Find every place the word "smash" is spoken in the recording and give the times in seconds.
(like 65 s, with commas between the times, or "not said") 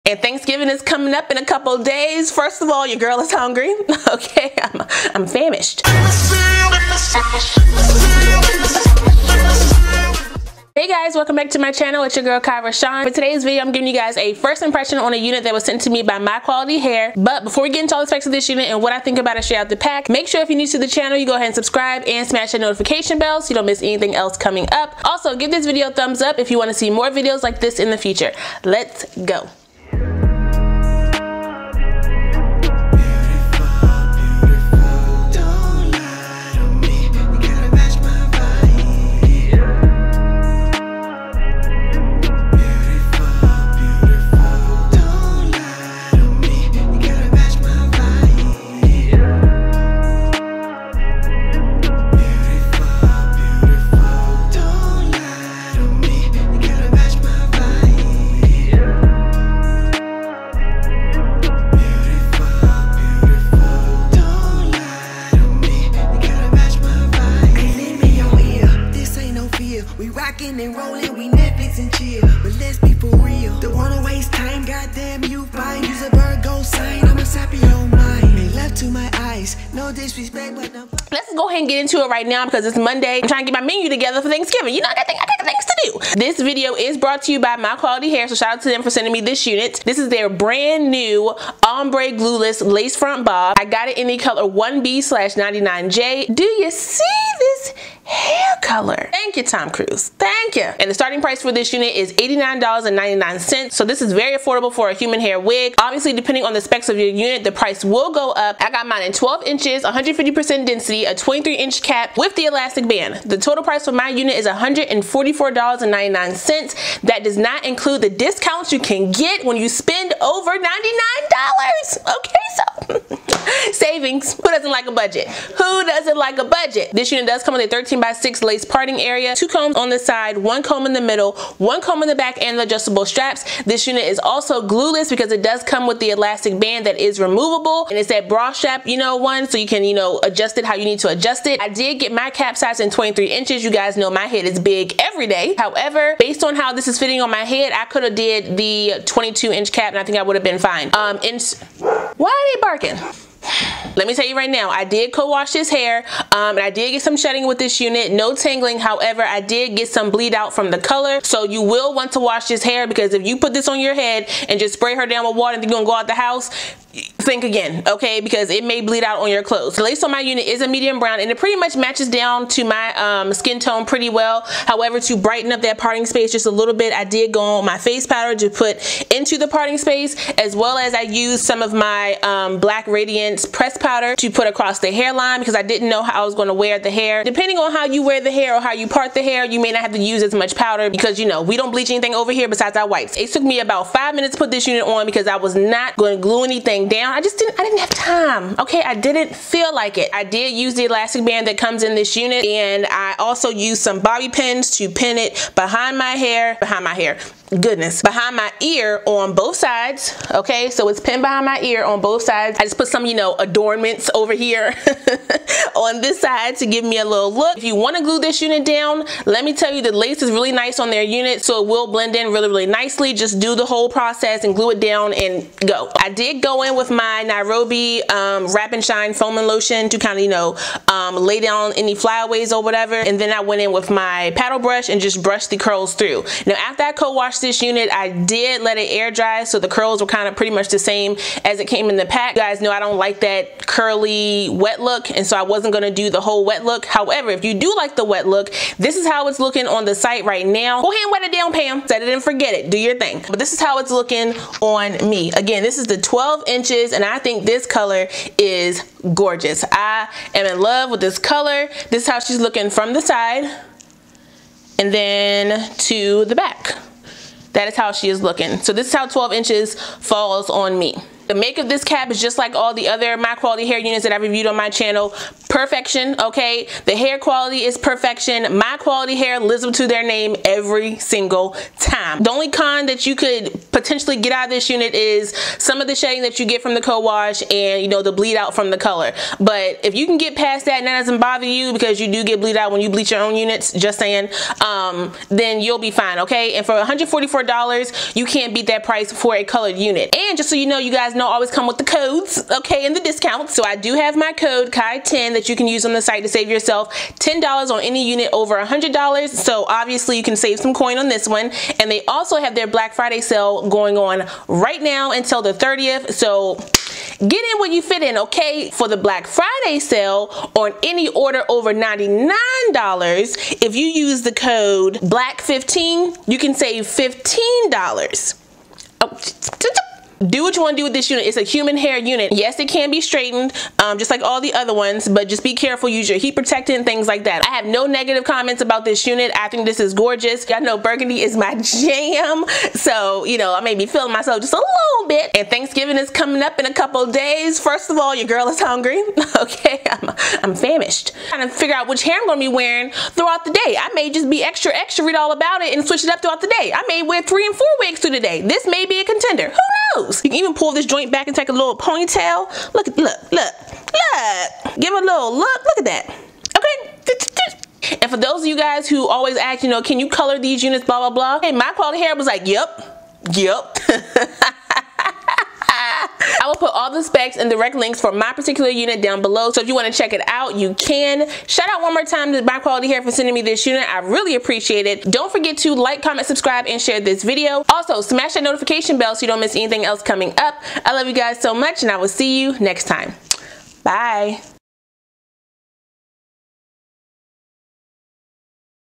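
22 s, 388 s.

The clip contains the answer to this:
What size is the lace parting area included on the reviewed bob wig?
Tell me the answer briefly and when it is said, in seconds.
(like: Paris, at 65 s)
13 by 6, at 127 s.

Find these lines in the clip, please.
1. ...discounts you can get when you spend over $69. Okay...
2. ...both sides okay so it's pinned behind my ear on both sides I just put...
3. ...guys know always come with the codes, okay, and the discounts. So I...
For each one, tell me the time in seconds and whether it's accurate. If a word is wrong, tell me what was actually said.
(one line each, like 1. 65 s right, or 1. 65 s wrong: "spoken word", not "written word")
1. 118 s wrong: "99", not "69"
2. 209 s right
3. 300 s right.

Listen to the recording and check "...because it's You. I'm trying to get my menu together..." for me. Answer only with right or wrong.
wrong.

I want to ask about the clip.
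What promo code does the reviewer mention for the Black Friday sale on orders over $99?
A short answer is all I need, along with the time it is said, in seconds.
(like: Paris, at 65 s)
BLACK15, at 324 s.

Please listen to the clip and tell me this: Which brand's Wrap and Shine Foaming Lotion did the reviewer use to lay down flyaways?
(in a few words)
Nairobi.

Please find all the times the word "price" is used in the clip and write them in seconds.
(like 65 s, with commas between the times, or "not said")
101 s, 107 s, 113 s, 298 s.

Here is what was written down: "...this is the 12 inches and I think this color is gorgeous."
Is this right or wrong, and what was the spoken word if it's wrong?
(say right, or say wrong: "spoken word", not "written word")
right.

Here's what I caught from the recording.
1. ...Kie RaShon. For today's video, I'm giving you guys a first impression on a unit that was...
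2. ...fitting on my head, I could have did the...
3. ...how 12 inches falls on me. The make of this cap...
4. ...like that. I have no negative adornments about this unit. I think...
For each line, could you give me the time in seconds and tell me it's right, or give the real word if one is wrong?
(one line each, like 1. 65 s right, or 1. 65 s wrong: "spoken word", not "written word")
1. 12 s right
2. 146 s right
3. 268 s right
4. 337 s wrong: "comments", not "adornments".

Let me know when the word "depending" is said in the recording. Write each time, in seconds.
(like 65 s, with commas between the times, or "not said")
106 s, 187 s.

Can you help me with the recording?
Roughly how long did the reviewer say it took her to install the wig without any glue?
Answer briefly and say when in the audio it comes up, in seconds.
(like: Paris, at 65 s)
five minutes, at 193 s.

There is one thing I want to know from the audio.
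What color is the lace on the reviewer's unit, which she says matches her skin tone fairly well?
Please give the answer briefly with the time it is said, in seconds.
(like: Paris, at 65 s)
medium brown, at 170 s.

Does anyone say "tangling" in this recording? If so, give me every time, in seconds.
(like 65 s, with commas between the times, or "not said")
158 s.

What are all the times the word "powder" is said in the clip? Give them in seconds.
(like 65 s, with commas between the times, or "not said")
178 s, 183 s, 190 s.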